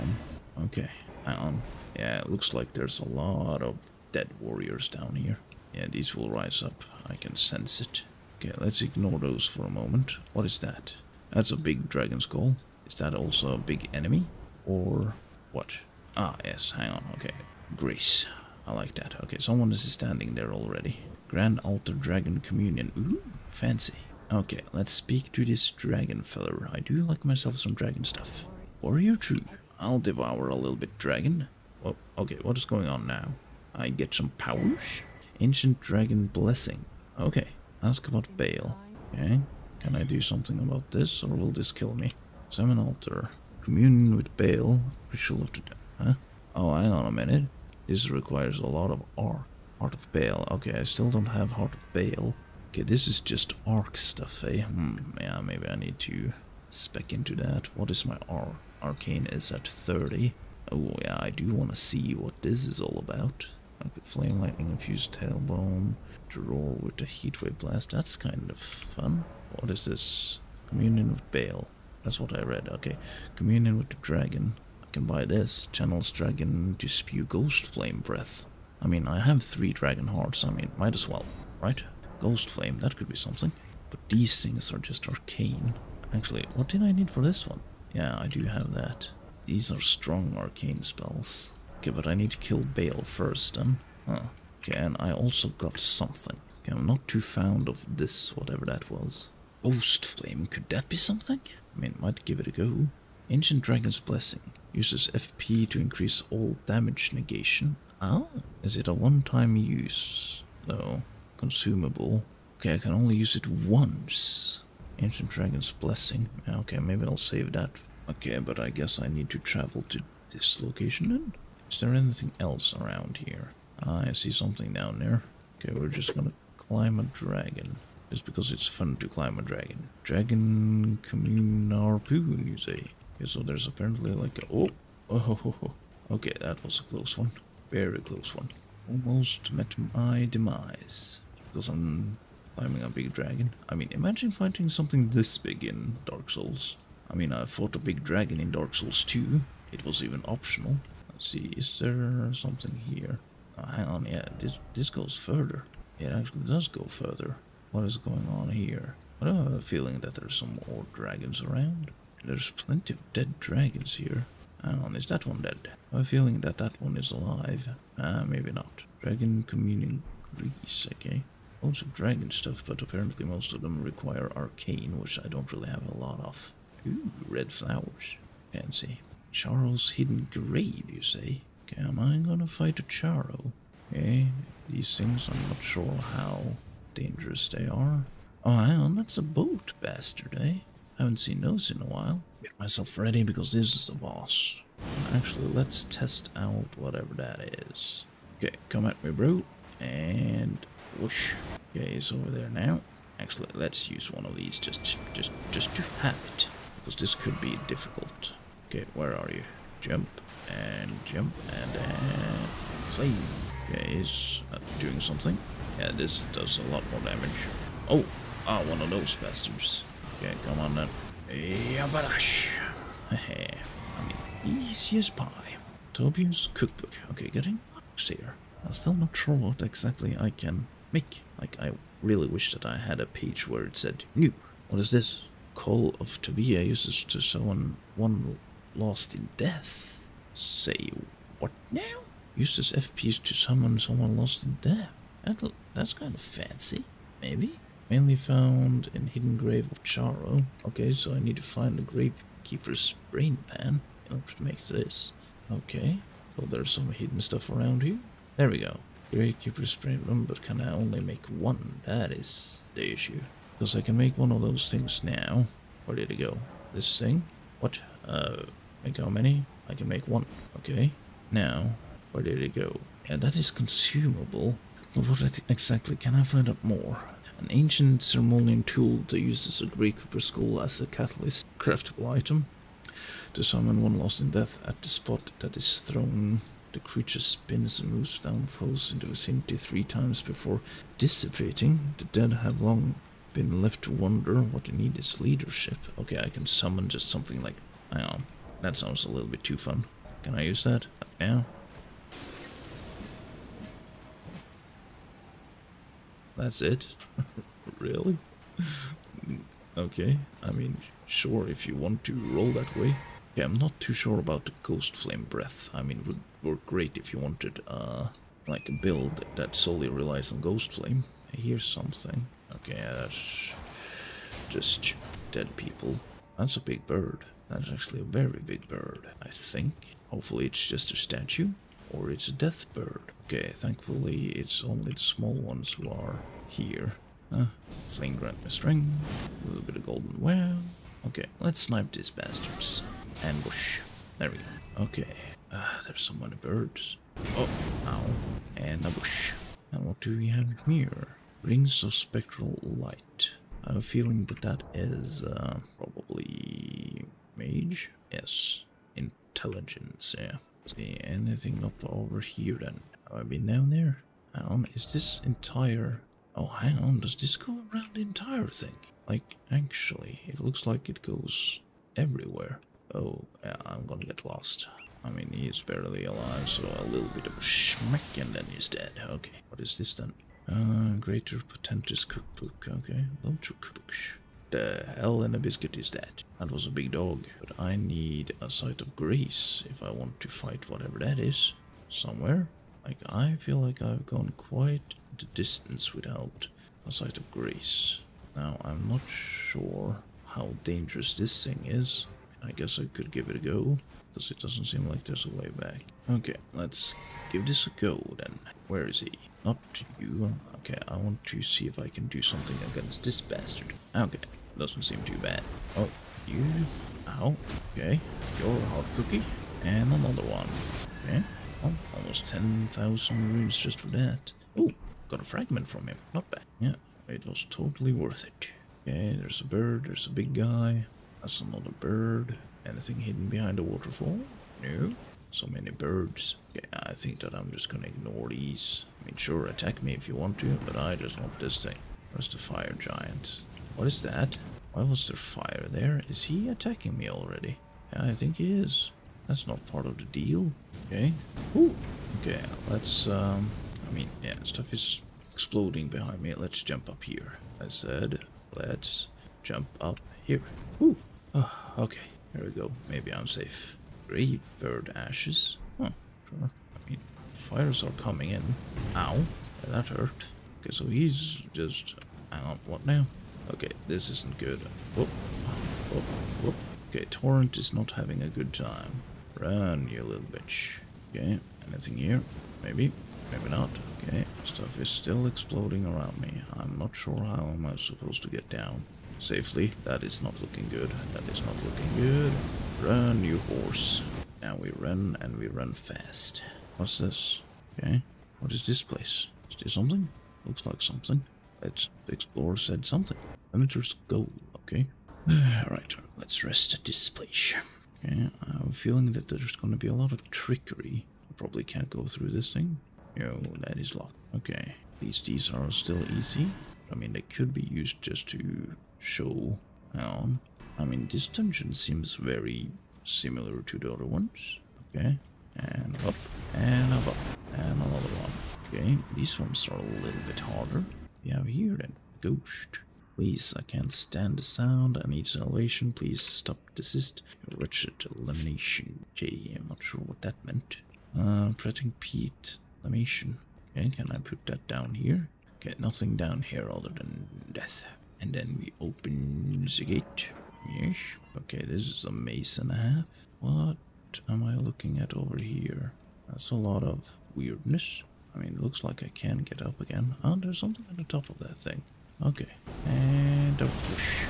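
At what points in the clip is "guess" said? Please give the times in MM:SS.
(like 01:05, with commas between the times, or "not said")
01:58, 06:42.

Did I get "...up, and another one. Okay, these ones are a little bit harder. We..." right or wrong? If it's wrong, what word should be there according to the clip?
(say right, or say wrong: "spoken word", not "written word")
right.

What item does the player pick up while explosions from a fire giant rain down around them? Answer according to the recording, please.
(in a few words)
Grave bird ashes.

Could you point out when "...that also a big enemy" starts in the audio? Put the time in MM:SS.
00:12.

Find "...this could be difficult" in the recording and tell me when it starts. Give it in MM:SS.
03:26.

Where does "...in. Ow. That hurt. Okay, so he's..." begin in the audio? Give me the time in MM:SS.
07:48.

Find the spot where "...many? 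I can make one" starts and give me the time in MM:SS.
04:29.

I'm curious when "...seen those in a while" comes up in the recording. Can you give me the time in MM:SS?
03:11.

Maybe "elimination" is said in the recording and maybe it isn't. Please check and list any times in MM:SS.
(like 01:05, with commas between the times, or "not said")
08:58, 09:02.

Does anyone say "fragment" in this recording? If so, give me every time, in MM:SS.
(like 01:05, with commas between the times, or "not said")
07:05.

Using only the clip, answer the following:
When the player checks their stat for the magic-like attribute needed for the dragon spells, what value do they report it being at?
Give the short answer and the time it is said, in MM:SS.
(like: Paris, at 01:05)
30, at 00:58.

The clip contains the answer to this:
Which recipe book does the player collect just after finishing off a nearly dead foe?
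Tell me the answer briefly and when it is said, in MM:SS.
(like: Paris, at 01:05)
Greater Potentate's Cookbook, at 06:20.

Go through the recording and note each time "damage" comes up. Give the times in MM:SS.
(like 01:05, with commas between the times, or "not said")
01:46, 03:37.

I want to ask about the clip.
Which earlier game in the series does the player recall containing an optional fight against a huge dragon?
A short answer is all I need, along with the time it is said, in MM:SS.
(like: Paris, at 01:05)
Dark Souls 2, at 02:28.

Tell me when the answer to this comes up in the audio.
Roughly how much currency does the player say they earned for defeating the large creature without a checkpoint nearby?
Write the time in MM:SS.
07:01.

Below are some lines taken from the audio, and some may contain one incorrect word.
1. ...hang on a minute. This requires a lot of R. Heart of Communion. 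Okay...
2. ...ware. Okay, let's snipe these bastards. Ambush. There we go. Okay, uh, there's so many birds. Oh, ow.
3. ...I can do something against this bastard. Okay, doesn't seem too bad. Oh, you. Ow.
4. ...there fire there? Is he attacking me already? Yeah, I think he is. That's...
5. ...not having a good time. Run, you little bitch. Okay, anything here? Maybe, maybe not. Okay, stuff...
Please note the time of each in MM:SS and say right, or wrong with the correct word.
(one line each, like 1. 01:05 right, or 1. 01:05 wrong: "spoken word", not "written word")
1. 00:46 wrong: "Bayle", not "Communion"
2. 05:40 right
3. 06:51 right
4. 07:25 right
5. 07:57 right.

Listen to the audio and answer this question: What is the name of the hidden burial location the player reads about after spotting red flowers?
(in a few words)
Charo's hidden grave.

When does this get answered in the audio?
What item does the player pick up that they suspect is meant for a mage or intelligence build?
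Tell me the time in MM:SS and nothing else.
05:51.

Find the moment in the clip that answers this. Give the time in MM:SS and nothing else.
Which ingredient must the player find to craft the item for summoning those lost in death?
04:11.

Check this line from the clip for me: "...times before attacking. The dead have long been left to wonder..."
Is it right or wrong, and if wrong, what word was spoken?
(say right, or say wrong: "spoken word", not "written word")
wrong: "dissipating", not "attacking".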